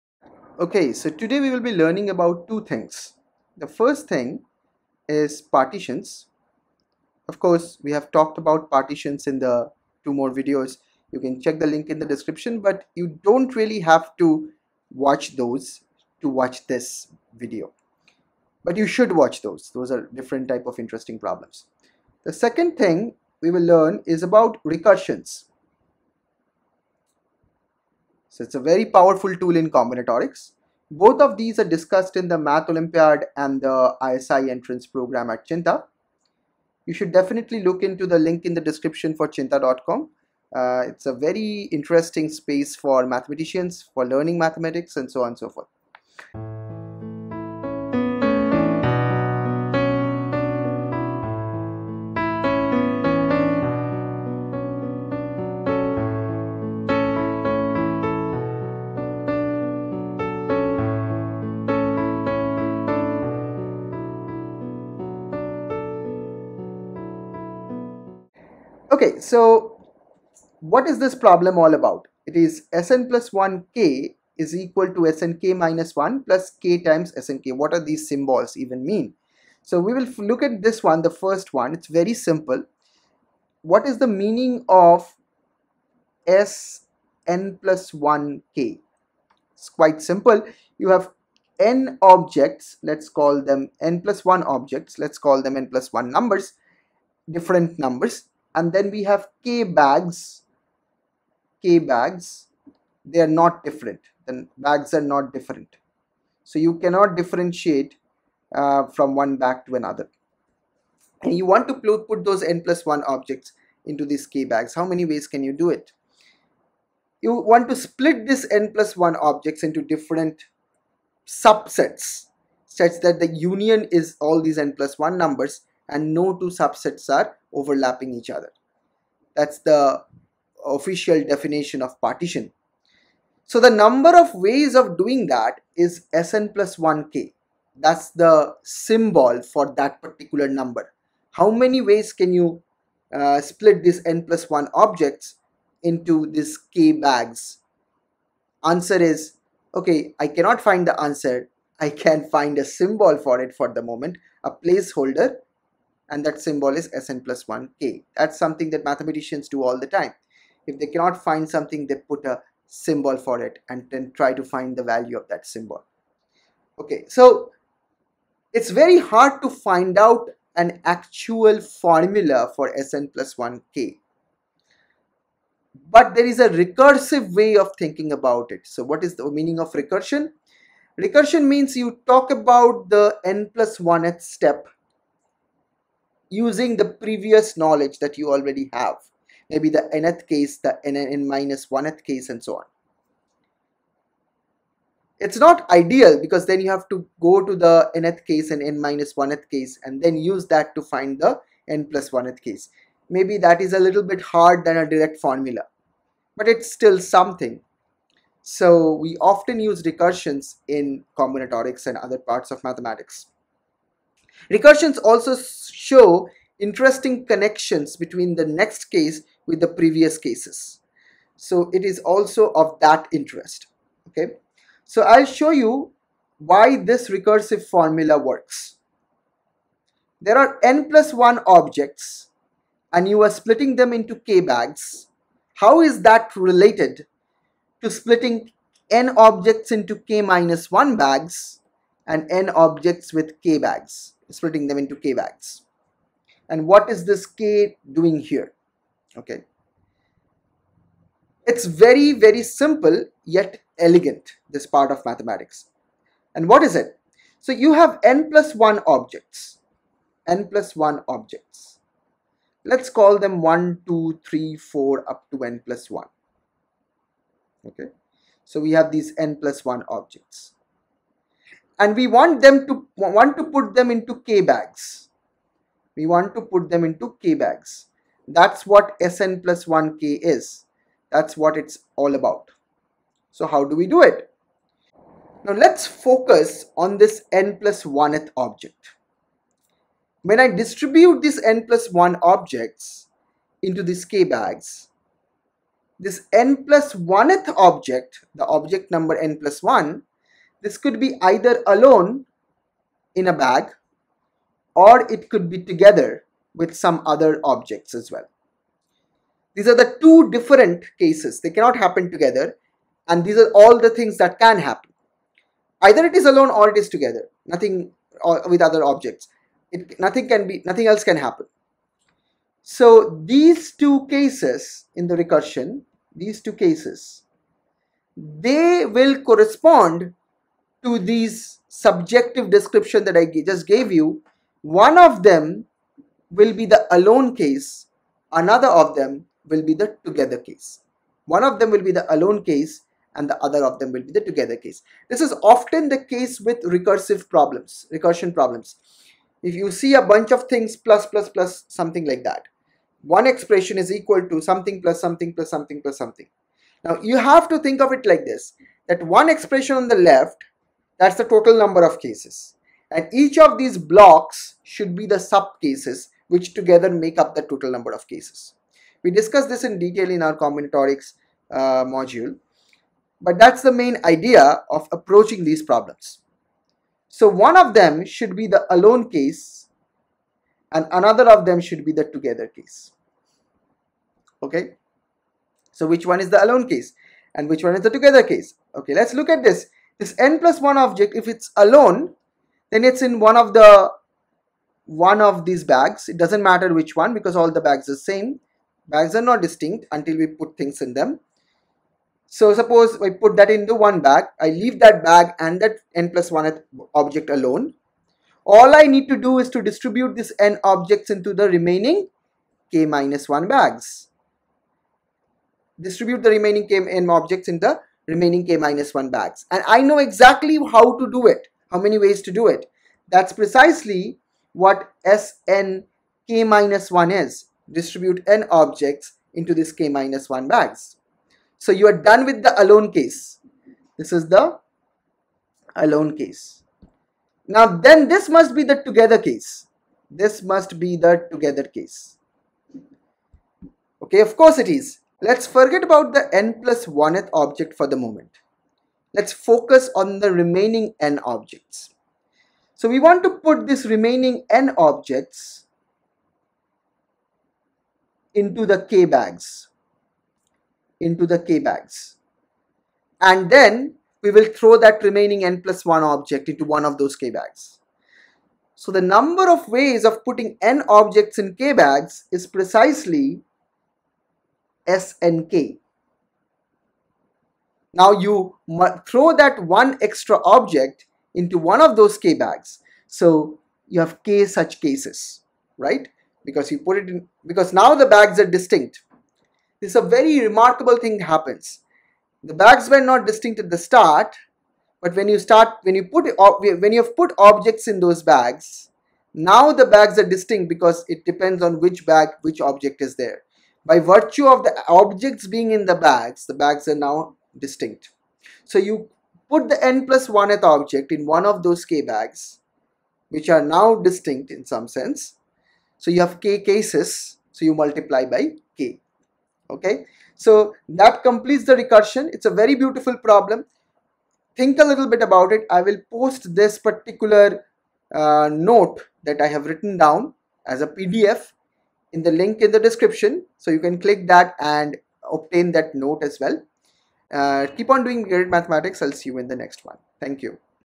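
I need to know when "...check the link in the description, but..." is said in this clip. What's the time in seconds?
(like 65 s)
11 s.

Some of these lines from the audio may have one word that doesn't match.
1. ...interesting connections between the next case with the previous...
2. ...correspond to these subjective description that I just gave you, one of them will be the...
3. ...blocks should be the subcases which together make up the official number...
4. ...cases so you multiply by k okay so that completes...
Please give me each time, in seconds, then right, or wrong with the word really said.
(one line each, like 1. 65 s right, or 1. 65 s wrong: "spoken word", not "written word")
1. 216 s right
2. 329 s right
3. 363 s wrong: "total", not "official"
4. 516 s right.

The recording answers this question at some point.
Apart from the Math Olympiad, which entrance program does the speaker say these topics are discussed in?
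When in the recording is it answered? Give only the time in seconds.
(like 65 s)
34 s.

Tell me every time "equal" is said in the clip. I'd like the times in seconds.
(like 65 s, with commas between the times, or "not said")
74 s, 353 s.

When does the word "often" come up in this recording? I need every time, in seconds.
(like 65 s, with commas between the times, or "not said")
209 s, 345 s.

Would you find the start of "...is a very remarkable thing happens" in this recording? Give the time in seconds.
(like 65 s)
489 s.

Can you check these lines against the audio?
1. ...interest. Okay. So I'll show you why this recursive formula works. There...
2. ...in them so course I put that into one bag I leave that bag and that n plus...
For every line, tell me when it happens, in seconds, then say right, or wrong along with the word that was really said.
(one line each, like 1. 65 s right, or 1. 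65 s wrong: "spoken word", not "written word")
1. 223 s right
2. 400 s wrong: "suppose", not "course".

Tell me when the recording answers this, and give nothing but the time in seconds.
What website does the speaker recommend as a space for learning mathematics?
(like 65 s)
39 s.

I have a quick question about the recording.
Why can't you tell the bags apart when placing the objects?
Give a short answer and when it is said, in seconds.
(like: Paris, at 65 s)
They are not different, at 103 s.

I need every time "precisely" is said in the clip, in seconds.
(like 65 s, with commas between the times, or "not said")
423 s, 472 s.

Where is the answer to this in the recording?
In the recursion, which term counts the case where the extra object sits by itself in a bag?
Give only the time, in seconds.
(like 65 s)
425 s.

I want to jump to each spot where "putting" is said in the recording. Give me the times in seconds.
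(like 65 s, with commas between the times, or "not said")
470 s.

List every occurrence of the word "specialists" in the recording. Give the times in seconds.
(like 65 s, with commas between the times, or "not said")
not said.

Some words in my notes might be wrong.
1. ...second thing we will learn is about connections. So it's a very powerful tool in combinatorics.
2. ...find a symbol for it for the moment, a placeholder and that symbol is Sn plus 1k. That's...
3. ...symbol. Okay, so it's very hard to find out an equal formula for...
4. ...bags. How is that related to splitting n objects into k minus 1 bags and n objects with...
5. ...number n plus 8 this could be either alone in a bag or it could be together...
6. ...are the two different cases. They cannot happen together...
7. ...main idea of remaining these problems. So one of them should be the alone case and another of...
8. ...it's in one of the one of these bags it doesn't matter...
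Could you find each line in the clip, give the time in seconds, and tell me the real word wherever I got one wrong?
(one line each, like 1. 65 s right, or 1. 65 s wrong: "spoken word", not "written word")
1. 22 s wrong: "recursions", not "connections"
2. 152 s right
3. 165 s wrong: "actual", not "equal"
4. 234 s right
5. 298 s wrong: "1", not "8"
6. 309 s right
7. 373 s wrong: "approaching", not "remaining"
8. 392 s right.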